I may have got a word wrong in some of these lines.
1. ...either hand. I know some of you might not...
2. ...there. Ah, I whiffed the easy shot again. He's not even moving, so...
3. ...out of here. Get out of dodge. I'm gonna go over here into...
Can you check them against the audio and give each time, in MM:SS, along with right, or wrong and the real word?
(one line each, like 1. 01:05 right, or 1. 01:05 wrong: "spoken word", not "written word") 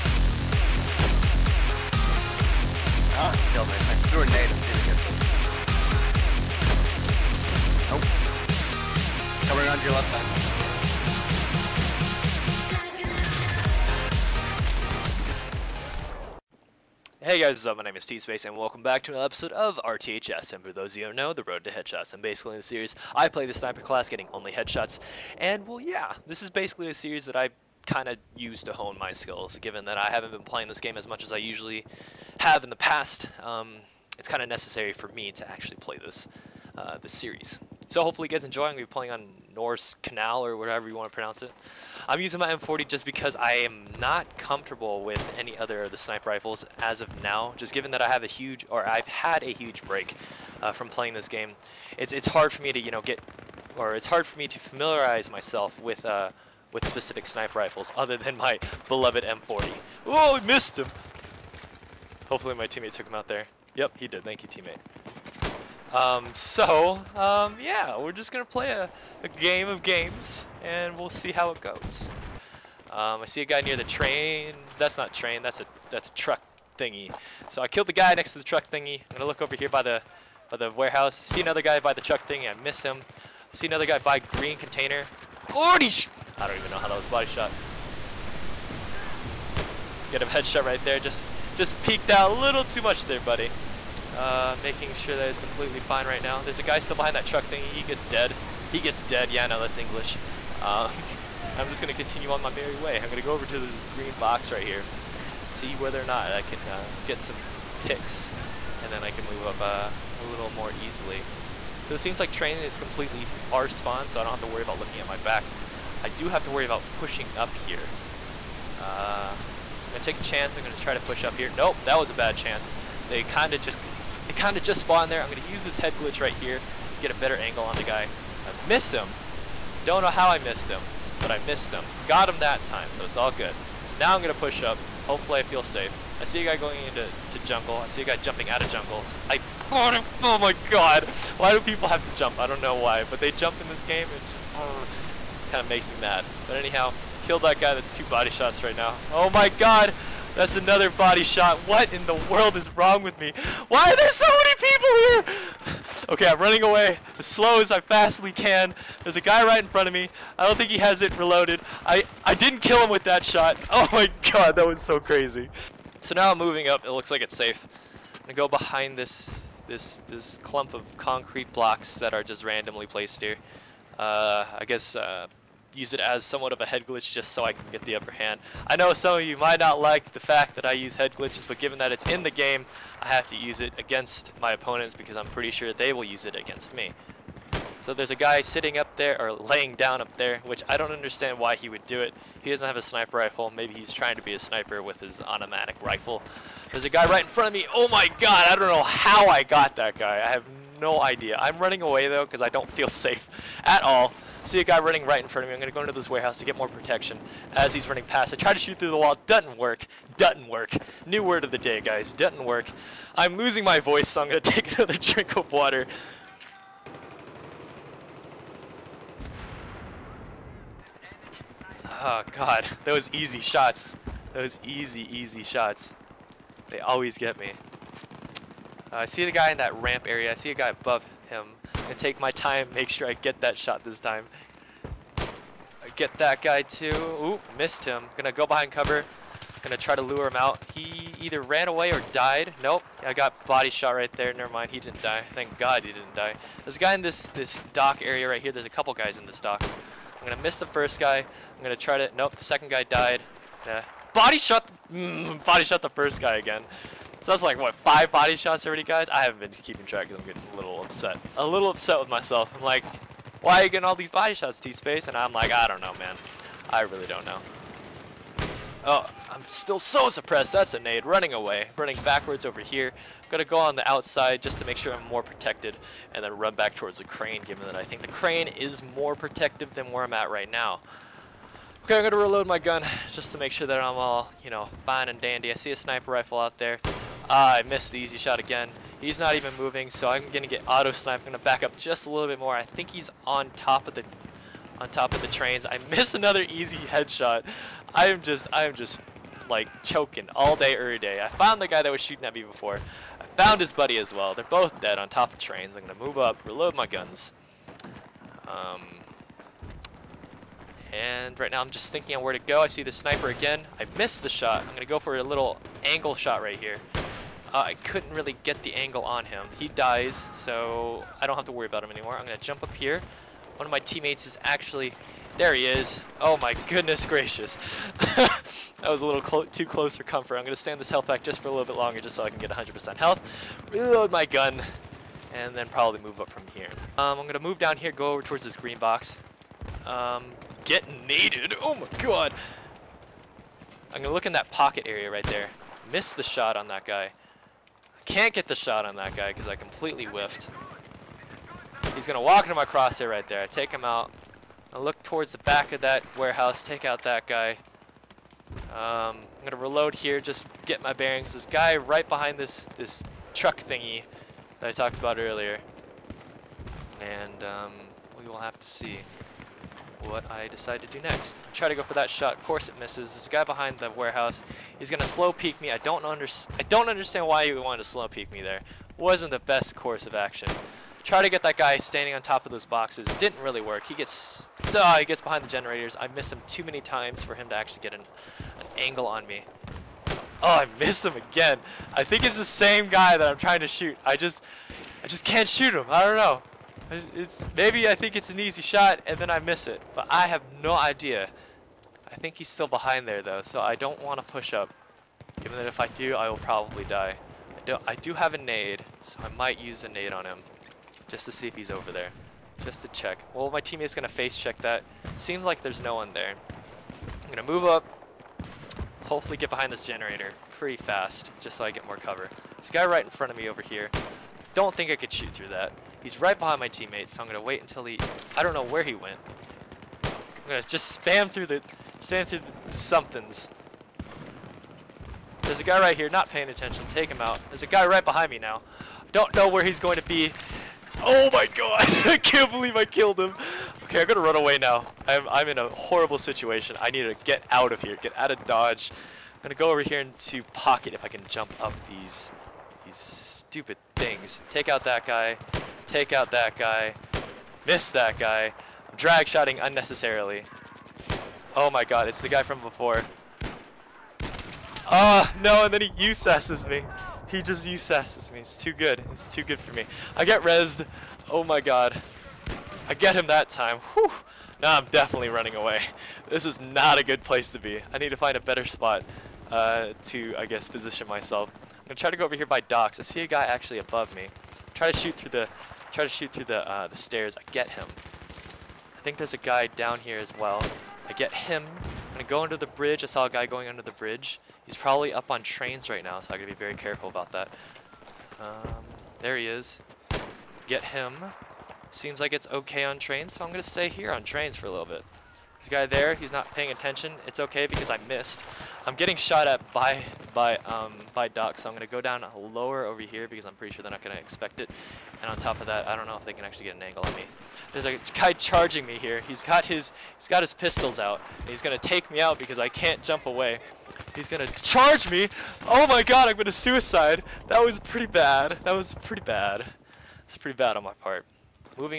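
1. 02:57 wrong: "upper", not "either"
2. 04:46 wrong: "missed", not "whiffed"
3. 07:27 right.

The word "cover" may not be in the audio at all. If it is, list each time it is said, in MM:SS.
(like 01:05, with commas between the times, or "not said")
03:58, 07:01.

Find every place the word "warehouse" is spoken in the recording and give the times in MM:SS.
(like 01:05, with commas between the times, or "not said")
01:20, 03:26, 05:56, 06:13.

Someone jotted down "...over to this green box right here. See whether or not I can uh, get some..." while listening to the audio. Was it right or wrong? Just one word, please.
right.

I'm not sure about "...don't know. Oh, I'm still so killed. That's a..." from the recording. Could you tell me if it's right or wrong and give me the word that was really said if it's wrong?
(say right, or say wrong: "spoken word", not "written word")
wrong: "suppressed", not "killed".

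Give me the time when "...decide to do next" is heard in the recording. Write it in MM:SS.
06:10.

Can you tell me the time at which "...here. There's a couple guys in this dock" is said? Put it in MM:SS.
04:08.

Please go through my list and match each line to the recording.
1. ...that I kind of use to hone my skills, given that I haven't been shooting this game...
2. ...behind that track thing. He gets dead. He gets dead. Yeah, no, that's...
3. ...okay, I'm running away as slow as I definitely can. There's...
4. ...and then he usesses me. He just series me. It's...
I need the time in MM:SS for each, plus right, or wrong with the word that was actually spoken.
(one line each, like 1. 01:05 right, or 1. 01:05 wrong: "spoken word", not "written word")
1. 00:27 wrong: "playing", not "shooting"
2. 01:36 wrong: "truck", not "track"
3. 02:36 wrong: "fastly", not "definitely"
4. 07:45 wrong: "usesses", not "series".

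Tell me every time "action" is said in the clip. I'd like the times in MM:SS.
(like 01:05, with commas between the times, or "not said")
06:20.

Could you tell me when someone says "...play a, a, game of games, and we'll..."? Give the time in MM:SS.
01:08.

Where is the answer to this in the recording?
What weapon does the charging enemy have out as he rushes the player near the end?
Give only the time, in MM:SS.
08:40.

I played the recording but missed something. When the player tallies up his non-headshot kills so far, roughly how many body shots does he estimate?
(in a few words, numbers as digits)
5.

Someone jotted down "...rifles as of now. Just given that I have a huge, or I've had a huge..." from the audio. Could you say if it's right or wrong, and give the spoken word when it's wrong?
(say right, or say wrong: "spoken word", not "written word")
right.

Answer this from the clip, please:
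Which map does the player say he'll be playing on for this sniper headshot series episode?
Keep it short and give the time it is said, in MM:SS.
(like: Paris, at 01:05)
Norse Canal, at 00:39.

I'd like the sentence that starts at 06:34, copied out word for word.
I just I just can't shoot him.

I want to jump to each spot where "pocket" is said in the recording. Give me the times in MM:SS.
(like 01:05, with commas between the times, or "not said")
05:44, 07:30.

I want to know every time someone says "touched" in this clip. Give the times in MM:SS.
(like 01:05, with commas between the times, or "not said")
not said.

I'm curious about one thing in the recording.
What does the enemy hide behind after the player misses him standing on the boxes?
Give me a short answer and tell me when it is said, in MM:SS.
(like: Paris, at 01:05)
generators, at 06:25.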